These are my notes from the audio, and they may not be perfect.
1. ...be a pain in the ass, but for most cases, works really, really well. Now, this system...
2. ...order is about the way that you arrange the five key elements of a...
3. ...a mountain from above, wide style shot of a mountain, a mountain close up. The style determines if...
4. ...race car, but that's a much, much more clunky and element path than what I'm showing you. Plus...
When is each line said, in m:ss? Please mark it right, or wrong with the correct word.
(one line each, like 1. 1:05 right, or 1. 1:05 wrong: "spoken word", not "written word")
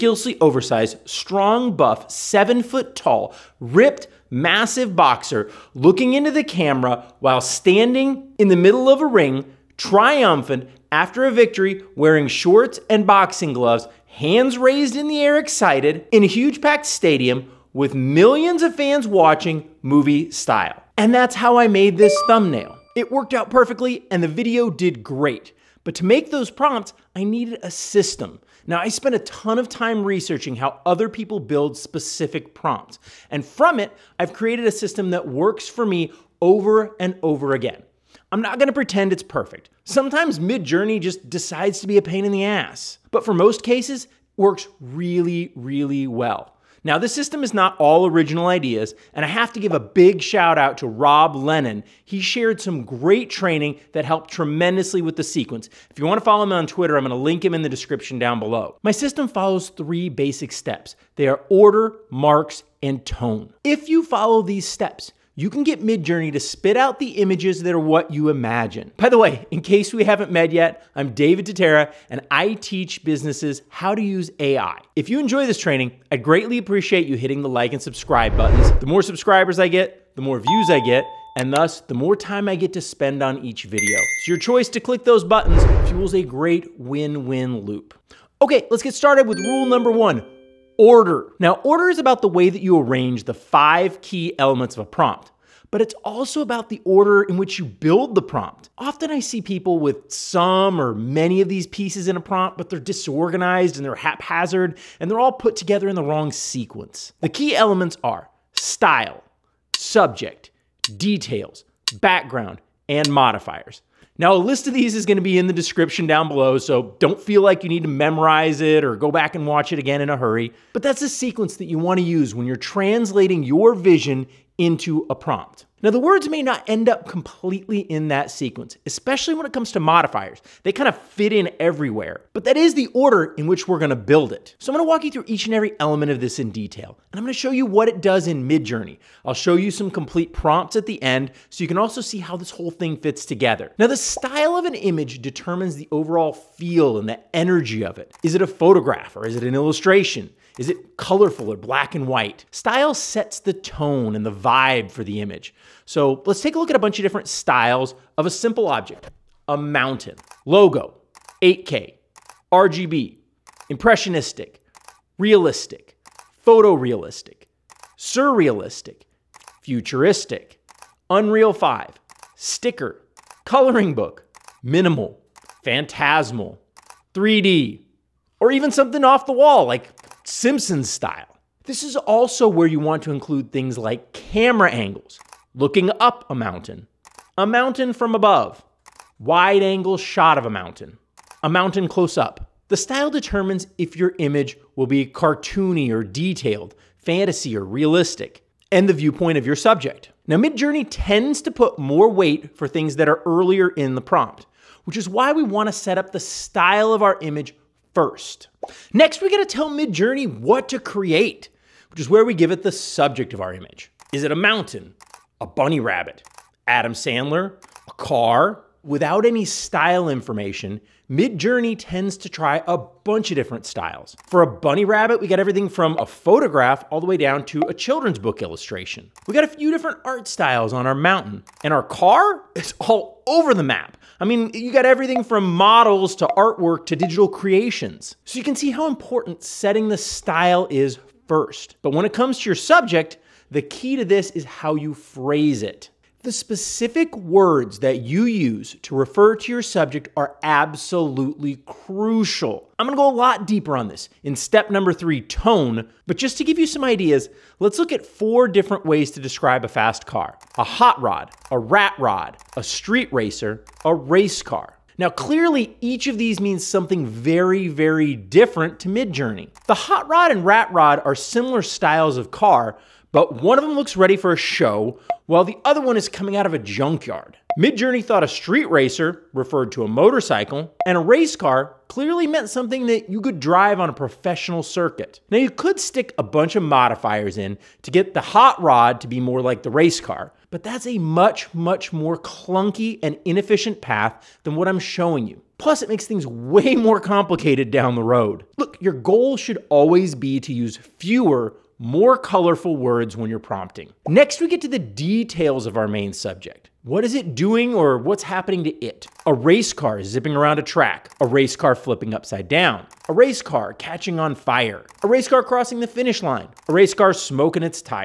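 1. 0:41 right
2. 1:31 right
3. 3:07 wrong: "angle", not "style"
4. 4:49 wrong: "inefficient", not "element".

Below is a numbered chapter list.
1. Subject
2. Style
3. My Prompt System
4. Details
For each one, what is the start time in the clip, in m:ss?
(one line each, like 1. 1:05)
1. 3:28
2. 2:23
3. 0:25
4. 5:04.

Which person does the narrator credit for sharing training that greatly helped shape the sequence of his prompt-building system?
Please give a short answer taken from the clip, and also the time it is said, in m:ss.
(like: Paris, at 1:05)
Rob Lennon, at 0:50.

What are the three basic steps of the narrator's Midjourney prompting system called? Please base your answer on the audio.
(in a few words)
order, marks, and tone.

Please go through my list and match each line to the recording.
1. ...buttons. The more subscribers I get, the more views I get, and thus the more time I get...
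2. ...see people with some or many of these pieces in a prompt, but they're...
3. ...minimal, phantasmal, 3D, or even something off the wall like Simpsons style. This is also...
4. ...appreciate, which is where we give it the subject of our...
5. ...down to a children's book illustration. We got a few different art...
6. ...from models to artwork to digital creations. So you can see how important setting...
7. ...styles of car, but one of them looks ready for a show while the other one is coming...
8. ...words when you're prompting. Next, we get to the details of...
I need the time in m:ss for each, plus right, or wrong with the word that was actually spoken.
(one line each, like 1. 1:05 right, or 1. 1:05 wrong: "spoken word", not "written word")
1. 1:18 right
2. 1:39 right
3. 2:54 right
4. 3:30 wrong: "create", not "appreciate"
5. 3:47 right
6. 3:55 right
7. 4:31 right
8. 5:02 right.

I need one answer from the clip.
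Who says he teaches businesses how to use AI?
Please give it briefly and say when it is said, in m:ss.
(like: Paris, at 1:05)
David Tatera, at 1:11.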